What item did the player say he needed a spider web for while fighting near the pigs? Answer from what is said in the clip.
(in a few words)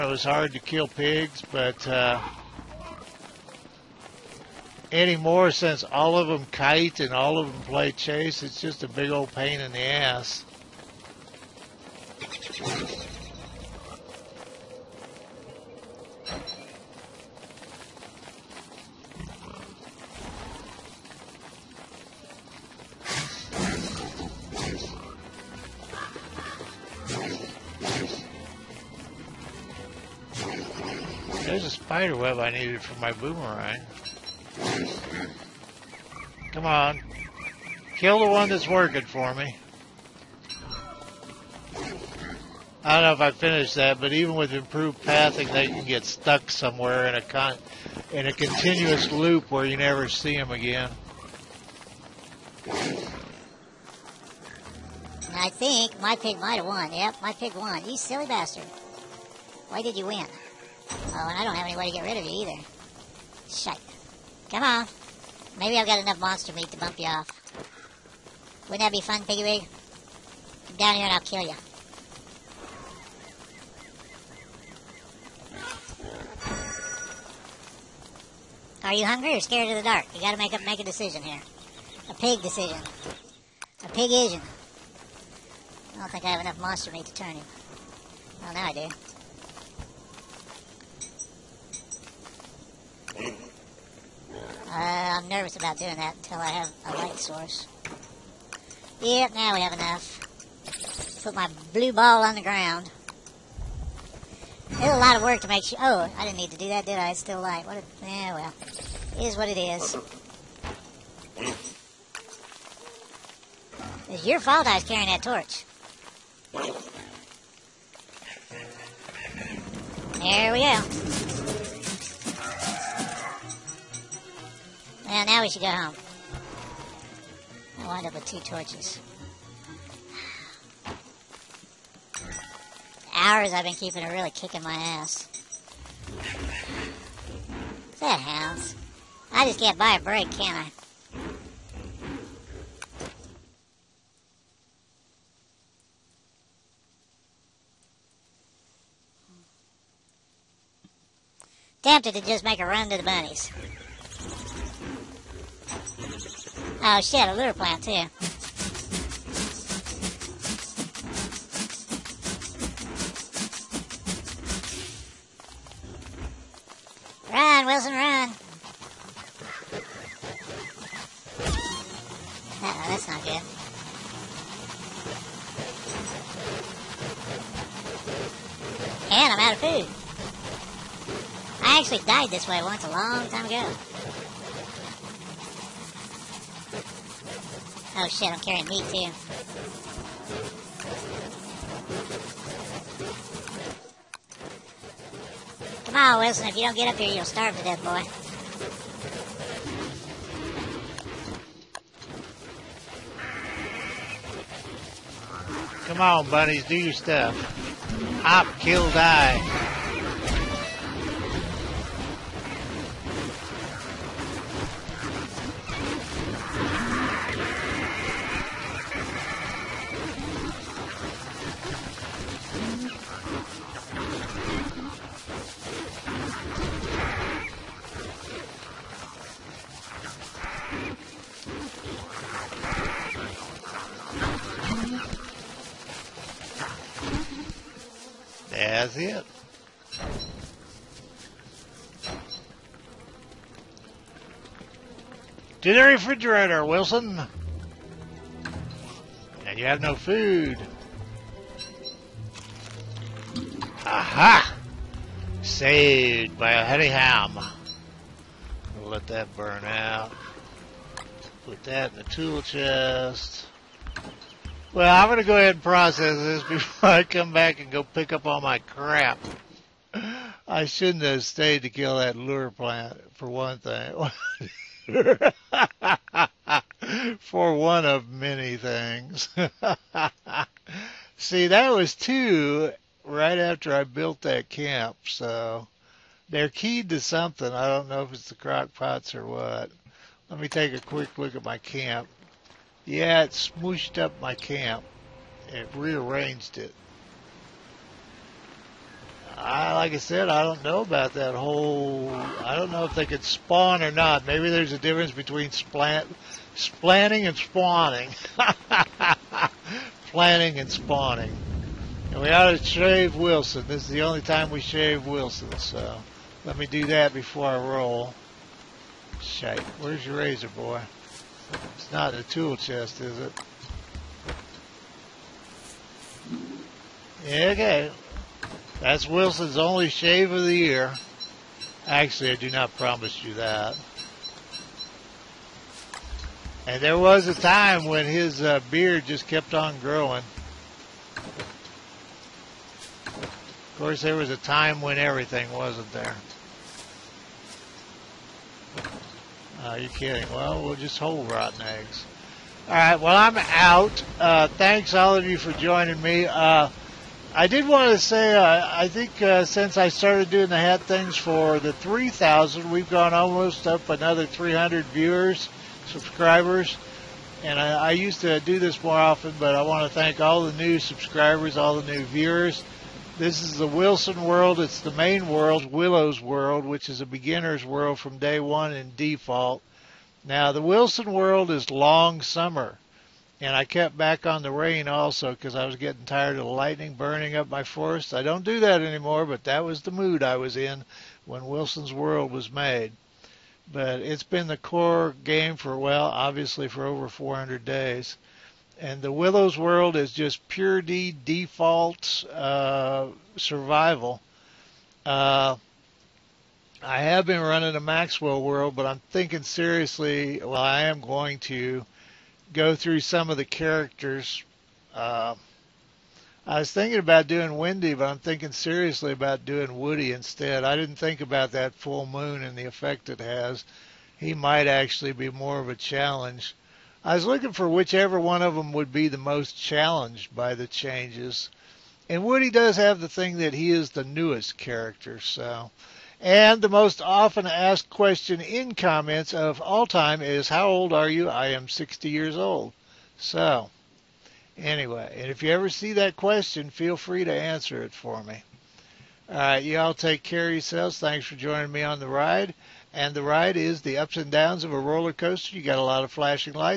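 Boomerang.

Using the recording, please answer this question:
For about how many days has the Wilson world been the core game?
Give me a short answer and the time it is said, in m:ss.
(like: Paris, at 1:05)
Over 400, at 6:36.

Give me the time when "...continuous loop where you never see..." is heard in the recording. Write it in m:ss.
0:48.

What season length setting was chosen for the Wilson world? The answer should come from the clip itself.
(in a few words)
Long summer.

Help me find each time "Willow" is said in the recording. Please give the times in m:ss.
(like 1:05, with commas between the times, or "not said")
6:15, 6:39.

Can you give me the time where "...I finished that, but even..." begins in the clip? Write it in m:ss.
0:43.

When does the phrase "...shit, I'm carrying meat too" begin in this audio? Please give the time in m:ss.
3:08.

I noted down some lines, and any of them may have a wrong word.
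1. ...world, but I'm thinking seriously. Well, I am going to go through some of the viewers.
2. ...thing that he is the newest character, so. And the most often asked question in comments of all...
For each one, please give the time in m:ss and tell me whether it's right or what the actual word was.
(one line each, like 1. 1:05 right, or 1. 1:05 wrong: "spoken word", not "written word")
1. 6:48 wrong: "characters", not "viewers"
2. 7:13 right.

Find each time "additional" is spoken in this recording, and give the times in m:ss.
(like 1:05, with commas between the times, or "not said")
not said.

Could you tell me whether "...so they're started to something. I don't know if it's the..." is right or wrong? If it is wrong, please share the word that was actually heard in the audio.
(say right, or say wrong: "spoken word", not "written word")
wrong: "keyed", not "started".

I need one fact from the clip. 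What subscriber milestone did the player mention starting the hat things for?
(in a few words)
3,000.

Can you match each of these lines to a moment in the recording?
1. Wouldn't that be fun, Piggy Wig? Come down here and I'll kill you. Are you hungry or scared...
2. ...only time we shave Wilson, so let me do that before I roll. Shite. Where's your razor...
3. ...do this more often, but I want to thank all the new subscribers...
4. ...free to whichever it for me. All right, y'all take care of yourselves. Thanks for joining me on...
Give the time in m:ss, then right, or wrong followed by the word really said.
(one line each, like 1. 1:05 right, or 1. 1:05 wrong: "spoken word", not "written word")
1. 1:08 right
2. 5:14 right
3. 6:08 right
4. 7:26 wrong: "answer", not "whichever".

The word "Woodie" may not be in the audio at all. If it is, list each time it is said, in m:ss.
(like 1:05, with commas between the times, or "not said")
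6:59, 7:12.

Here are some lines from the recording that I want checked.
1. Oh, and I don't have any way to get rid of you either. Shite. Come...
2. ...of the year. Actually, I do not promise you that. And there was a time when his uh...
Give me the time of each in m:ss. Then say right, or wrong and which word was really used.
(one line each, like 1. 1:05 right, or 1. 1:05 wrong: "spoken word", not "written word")
1. 1:00 right
2. 5:30 right.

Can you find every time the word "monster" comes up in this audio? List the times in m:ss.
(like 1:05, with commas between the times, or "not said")
1:06, 1:26.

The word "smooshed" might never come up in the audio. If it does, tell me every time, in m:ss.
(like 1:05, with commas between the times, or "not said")
4:53.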